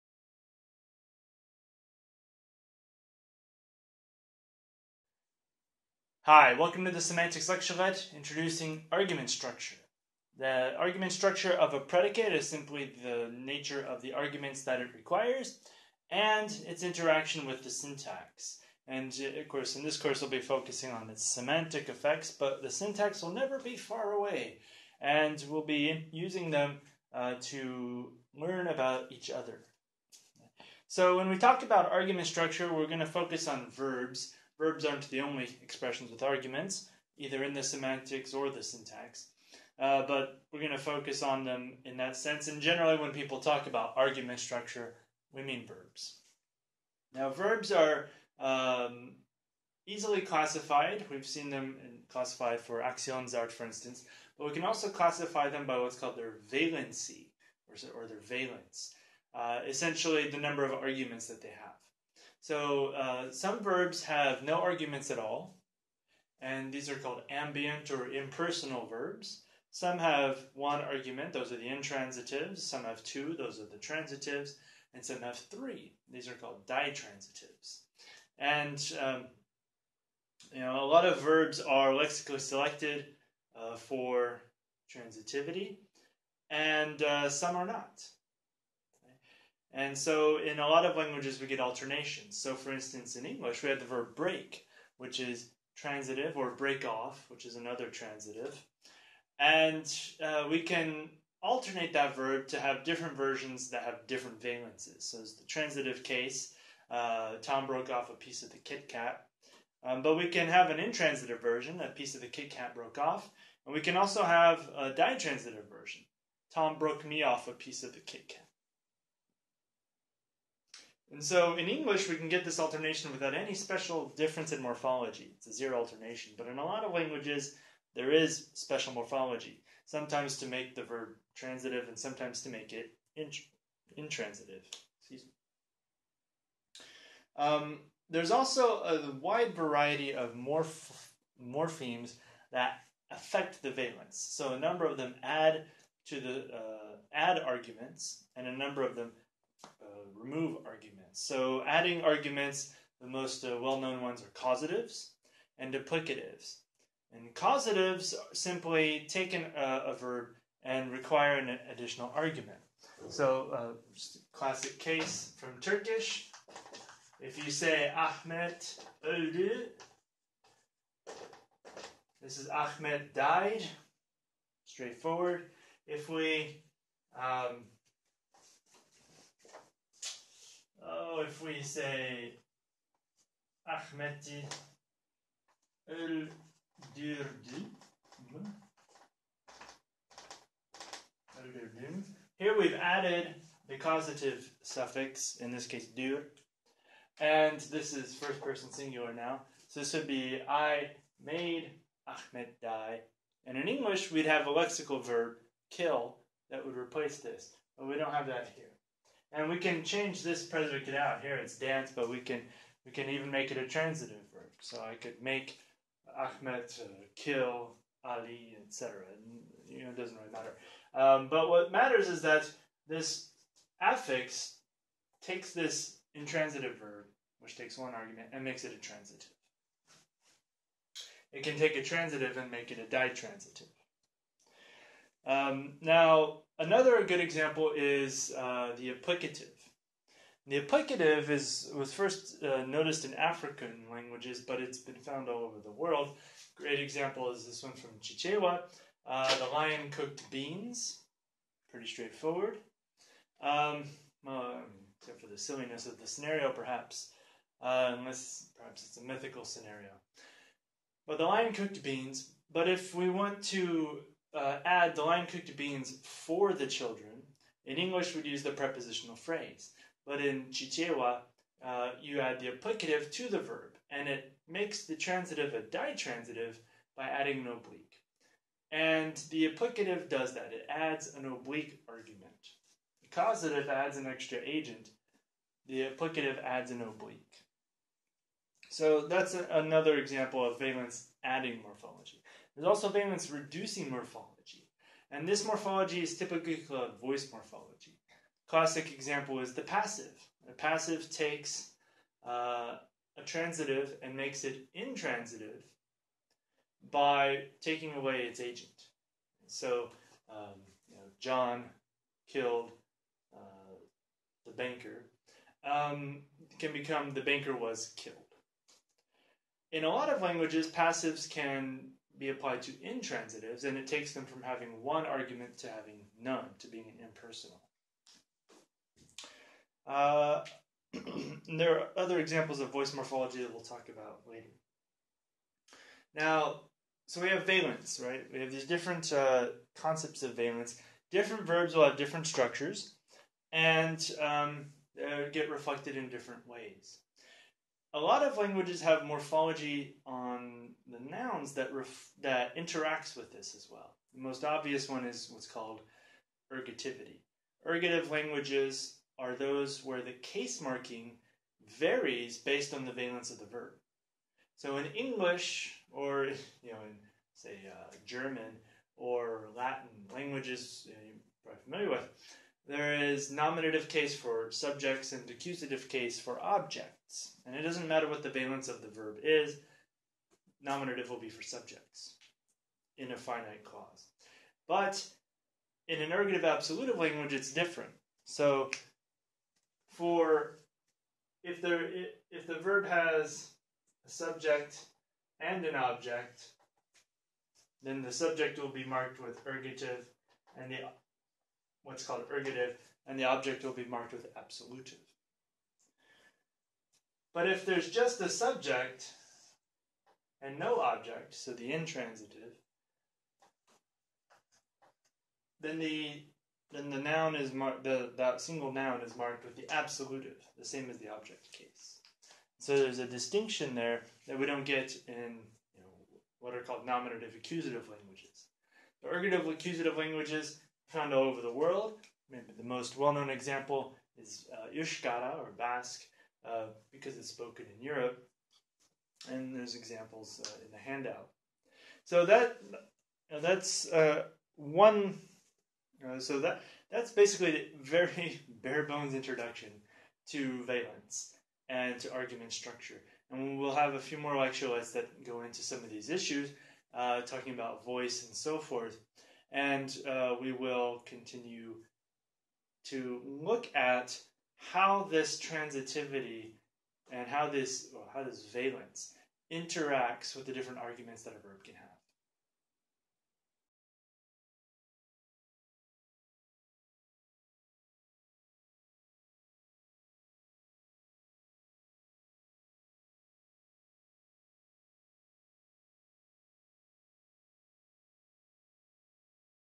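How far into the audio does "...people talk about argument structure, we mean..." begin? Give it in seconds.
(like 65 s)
43 s.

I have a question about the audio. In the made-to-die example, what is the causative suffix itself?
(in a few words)
dir.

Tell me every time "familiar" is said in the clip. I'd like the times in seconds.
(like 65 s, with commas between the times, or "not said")
371 s.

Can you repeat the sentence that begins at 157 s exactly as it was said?
And causatives simply take an, uh, a verb and require an additional argument.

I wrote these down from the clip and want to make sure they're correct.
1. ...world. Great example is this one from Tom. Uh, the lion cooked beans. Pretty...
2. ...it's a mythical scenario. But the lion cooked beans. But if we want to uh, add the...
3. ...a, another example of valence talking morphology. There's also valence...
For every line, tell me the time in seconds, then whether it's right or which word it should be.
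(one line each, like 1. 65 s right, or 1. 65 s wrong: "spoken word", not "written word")
1. 245 s wrong: "Chichewa", not "Tom"
2. 258 s right
3. 289 s wrong: "adding", not "talking".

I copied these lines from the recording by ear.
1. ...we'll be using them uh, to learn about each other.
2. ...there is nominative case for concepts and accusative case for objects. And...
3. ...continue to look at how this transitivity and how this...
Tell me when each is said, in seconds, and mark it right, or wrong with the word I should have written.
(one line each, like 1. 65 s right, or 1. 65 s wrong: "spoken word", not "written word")
1. 25 s right
2. 372 s wrong: "subjects", not "concepts"
3. 461 s right.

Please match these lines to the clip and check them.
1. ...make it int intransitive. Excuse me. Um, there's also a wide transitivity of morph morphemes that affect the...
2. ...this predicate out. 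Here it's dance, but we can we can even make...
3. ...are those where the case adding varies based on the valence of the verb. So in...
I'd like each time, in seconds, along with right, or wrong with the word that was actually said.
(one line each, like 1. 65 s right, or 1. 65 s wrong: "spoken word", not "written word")
1. 132 s wrong: "variety", not "transitivity"
2. 210 s right
3. 359 s wrong: "marking", not "adding".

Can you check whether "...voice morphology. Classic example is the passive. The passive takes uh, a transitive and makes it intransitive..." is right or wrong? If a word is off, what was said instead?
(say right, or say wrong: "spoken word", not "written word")
right.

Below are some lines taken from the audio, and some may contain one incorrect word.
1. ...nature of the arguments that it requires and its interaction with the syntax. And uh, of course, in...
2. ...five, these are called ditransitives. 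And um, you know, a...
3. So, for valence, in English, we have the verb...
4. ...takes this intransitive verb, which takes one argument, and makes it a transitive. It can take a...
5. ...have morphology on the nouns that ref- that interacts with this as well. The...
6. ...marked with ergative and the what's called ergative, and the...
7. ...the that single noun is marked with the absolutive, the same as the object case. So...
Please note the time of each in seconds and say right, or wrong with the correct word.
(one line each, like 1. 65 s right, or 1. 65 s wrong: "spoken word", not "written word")
1. 13 s right
2. 75 s wrong: "three", not "five"
3. 92 s wrong: "instance", not "valence"
4. 225 s right
5. 348 s right
6. 398 s right
7. 417 s right.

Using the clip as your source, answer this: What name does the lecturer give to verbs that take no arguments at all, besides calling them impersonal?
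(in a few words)
ambient.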